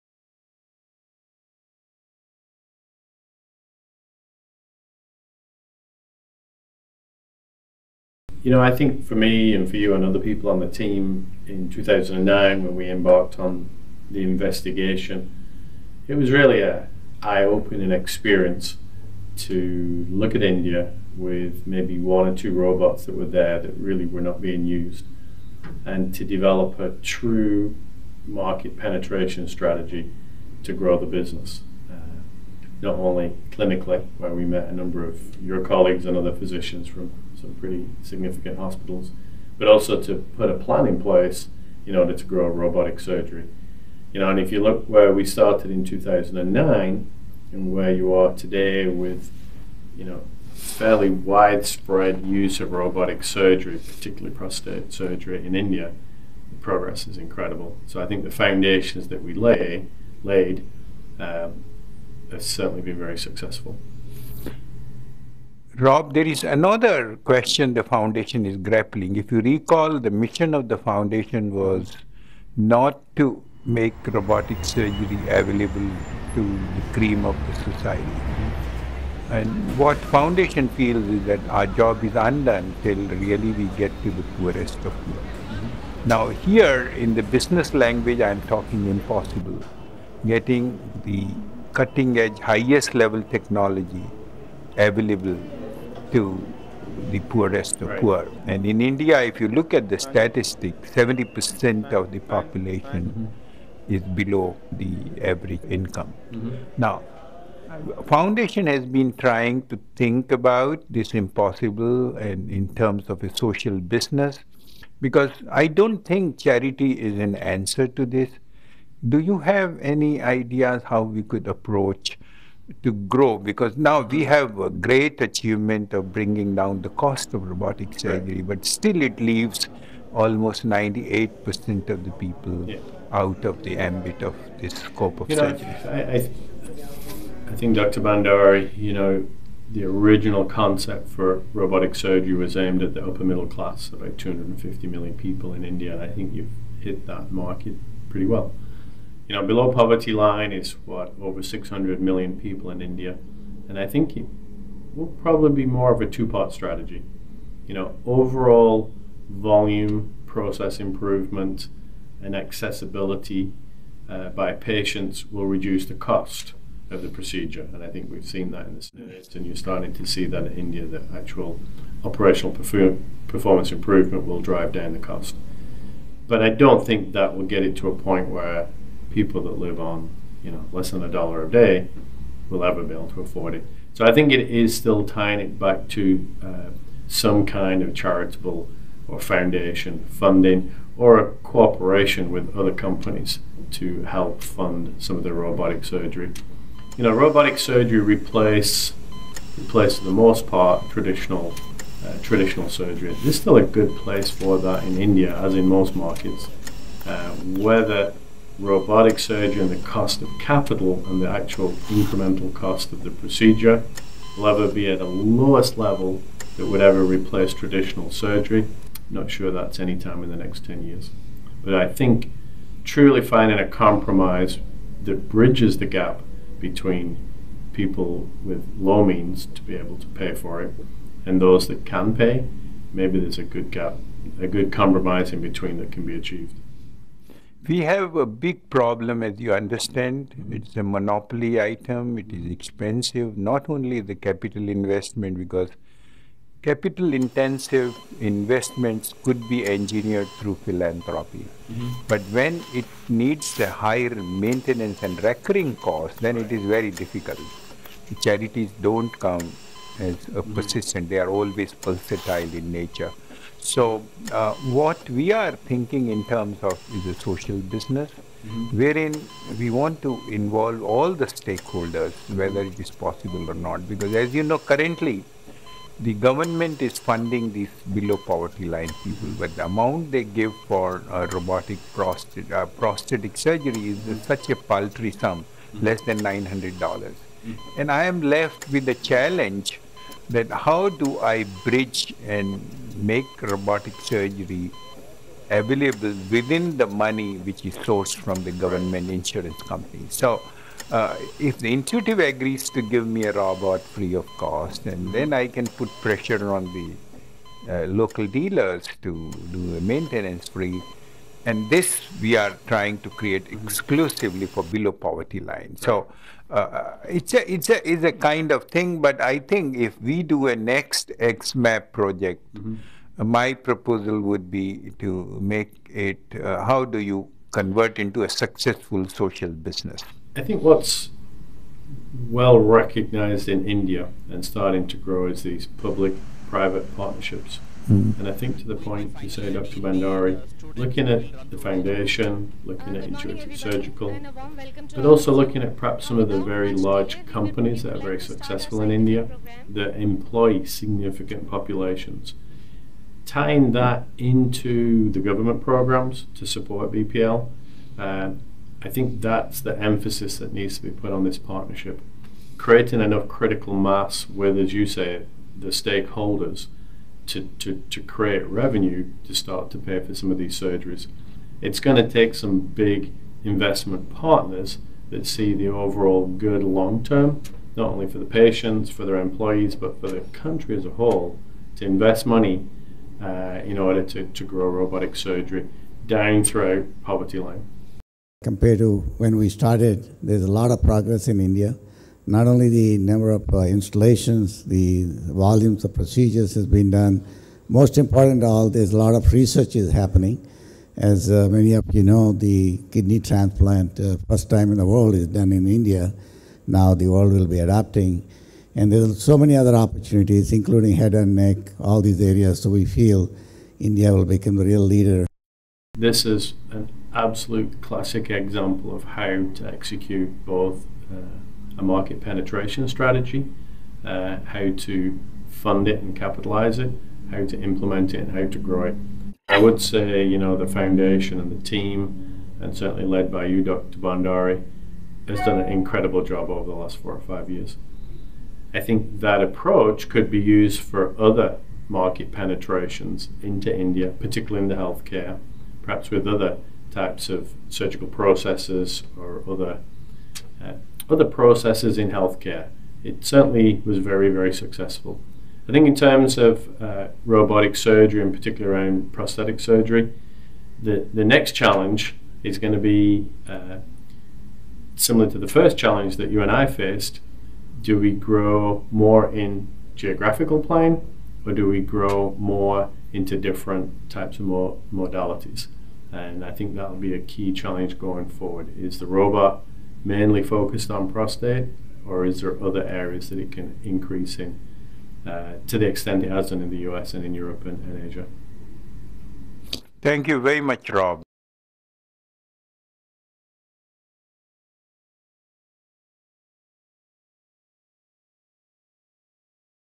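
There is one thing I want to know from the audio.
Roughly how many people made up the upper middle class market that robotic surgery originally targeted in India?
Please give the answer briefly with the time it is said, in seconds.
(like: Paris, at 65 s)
250 million, at 144 s.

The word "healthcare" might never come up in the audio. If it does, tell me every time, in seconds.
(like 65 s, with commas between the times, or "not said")
444 s, 452 s.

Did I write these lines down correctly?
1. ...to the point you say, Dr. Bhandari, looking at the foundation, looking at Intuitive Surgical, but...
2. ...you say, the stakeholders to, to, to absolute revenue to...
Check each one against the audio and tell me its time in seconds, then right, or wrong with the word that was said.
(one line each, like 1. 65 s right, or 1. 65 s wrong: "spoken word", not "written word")
1. 338 s right
2. 364 s wrong: "create", not "absolute".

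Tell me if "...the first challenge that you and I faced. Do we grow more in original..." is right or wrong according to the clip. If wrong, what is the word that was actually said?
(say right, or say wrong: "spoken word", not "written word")
wrong: "geographical", not "original".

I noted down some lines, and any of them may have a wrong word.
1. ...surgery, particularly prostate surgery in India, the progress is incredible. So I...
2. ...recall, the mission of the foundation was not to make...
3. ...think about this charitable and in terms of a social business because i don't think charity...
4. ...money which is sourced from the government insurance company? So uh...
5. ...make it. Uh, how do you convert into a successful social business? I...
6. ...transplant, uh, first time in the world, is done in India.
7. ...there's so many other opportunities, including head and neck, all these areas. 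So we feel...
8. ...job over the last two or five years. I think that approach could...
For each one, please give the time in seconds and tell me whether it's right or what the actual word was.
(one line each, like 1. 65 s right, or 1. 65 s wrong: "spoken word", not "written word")
1. 53 s right
2. 69 s right
3. 109 s wrong: "impossible", not "charitable"
4. 296 s right
5. 325 s right
6. 403 s right
7. 408 s right
8. 436 s wrong: "four", not "two".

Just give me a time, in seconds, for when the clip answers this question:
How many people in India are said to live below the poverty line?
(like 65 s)
151 s.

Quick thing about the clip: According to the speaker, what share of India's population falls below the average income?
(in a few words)
70%.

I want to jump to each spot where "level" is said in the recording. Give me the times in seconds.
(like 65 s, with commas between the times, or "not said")
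92 s, 215 s.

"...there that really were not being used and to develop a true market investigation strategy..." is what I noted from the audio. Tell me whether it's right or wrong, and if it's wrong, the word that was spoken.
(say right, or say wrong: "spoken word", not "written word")
wrong: "penetration", not "investigation".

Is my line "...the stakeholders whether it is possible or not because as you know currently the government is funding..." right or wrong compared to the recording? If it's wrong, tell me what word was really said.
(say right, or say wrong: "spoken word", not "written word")
right.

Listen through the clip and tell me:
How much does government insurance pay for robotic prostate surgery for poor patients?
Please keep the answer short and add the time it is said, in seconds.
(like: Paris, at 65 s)
less than $900, at 285 s.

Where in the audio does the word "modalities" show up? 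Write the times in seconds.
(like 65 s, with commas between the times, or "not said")
474 s.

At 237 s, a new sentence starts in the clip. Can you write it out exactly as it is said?
We have a big problem, as you understand.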